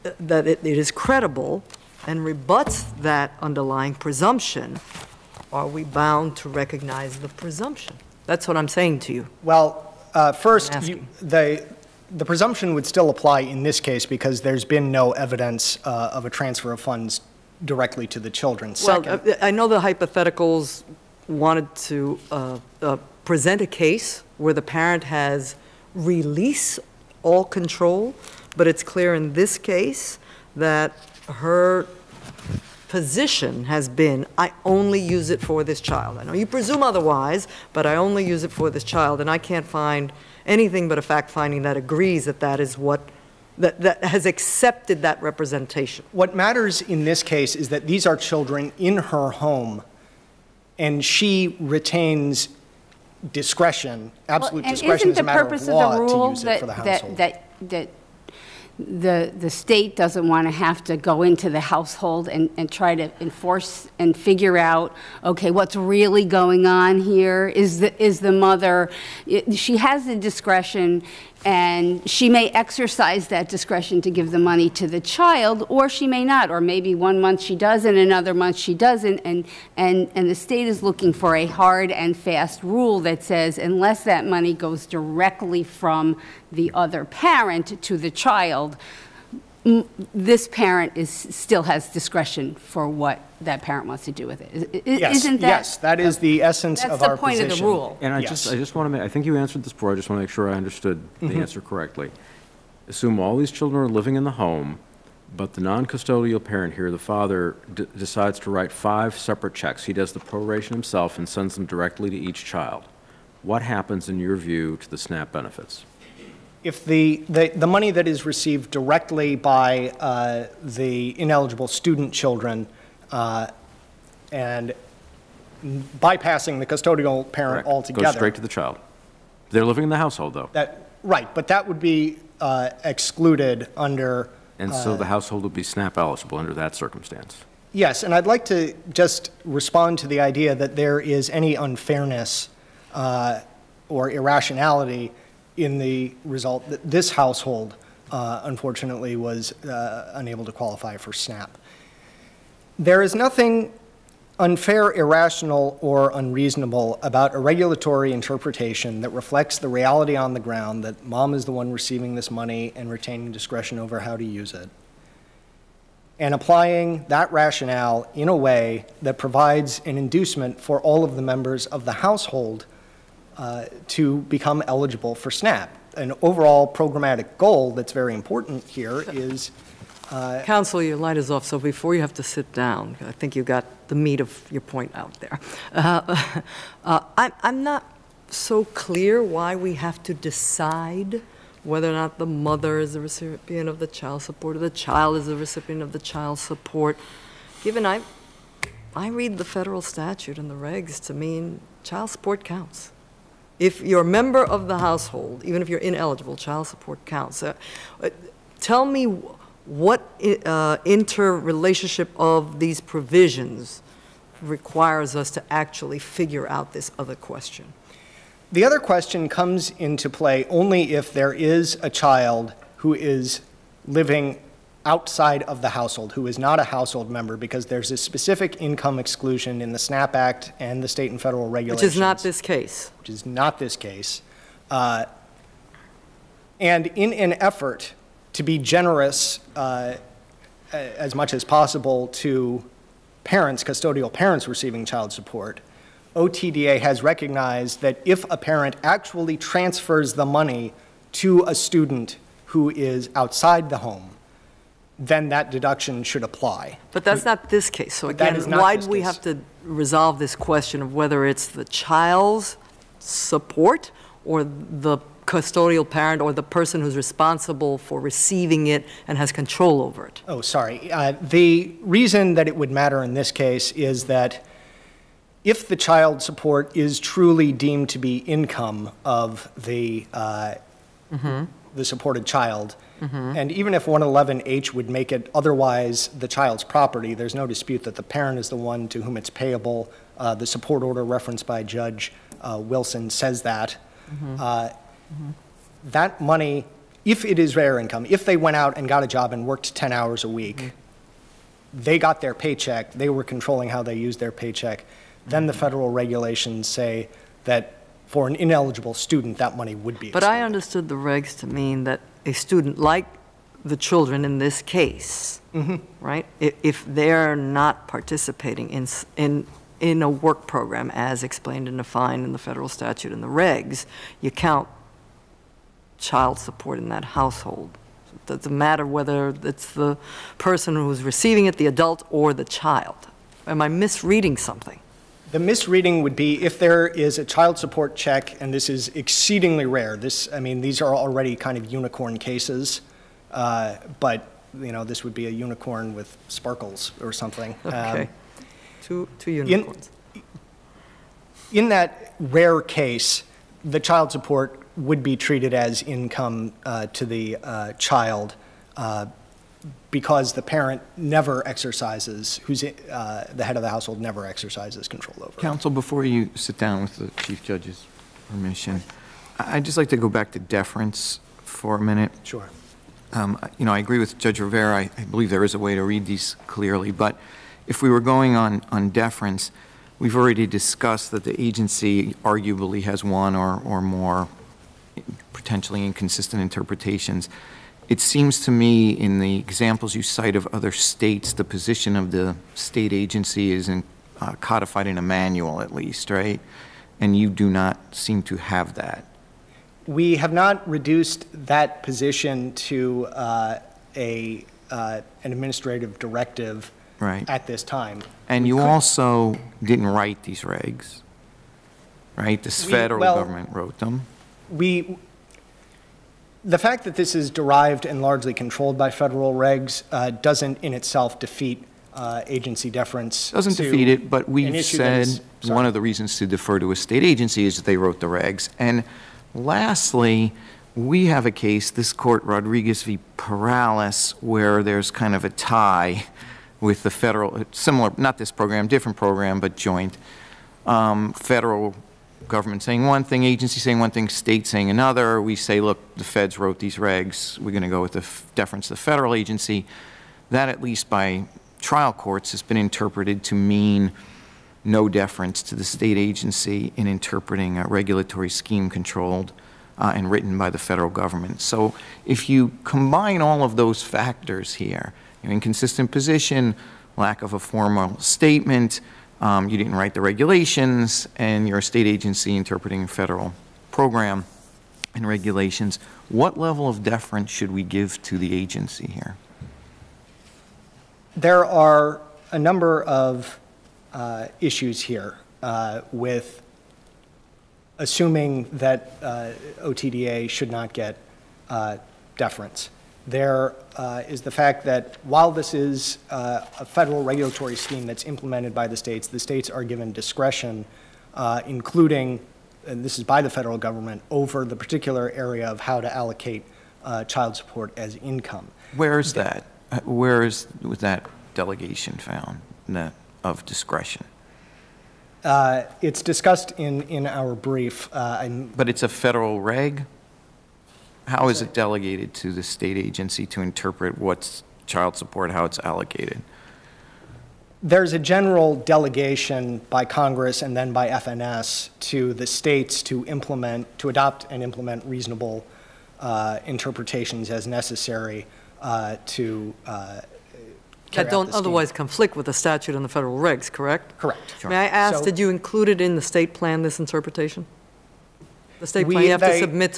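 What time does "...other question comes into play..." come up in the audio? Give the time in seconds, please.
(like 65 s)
218 s.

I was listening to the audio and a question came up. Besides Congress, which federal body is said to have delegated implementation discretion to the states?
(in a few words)
FNS.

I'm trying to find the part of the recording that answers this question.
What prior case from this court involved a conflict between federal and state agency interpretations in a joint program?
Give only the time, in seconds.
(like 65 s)
432 s.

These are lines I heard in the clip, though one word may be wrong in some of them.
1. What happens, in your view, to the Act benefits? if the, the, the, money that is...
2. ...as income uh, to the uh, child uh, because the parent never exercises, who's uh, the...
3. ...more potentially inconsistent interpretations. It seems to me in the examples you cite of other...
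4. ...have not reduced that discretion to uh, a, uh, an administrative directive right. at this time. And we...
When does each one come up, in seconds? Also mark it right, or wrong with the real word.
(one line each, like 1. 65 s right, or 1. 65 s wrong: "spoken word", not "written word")
1. 113 s wrong: "SNAP", not "Act"
2. 355 s right
3. 383 s right
4. 400 s wrong: "position", not "discretion".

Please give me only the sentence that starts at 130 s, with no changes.
That, right, but that would be uh, excluded under.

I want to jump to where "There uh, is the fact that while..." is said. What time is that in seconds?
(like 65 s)
493 s.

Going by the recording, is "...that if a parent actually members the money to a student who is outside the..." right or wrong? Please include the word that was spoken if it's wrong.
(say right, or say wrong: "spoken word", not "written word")
wrong: "transfers", not "members".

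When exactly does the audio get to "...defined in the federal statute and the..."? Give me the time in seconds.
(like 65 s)
321 s.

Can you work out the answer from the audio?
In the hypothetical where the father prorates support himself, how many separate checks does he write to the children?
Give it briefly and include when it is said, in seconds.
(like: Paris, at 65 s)
5, at 108 s.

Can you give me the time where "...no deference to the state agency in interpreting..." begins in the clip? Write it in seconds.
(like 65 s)
454 s.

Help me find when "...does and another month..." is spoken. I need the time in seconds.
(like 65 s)
77 s.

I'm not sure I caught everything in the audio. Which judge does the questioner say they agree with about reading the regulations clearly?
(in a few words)
Judge Rivera.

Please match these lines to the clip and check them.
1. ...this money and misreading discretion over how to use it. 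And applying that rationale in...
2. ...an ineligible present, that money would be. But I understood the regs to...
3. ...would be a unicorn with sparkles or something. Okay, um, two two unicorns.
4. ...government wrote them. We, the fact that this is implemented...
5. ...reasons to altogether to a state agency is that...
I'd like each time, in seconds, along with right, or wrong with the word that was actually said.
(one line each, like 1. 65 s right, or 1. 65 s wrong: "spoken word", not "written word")
1. 162 s wrong: "retaining", not "misreading"
2. 308 s wrong: "student", not "present"
3. 345 s right
4. 413 s wrong: "derived", not "implemented"
5. 425 s wrong: "defer", not "altogether".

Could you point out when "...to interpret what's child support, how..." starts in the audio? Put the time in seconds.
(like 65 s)
523 s.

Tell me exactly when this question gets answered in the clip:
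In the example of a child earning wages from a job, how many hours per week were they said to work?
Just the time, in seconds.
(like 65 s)
299 s.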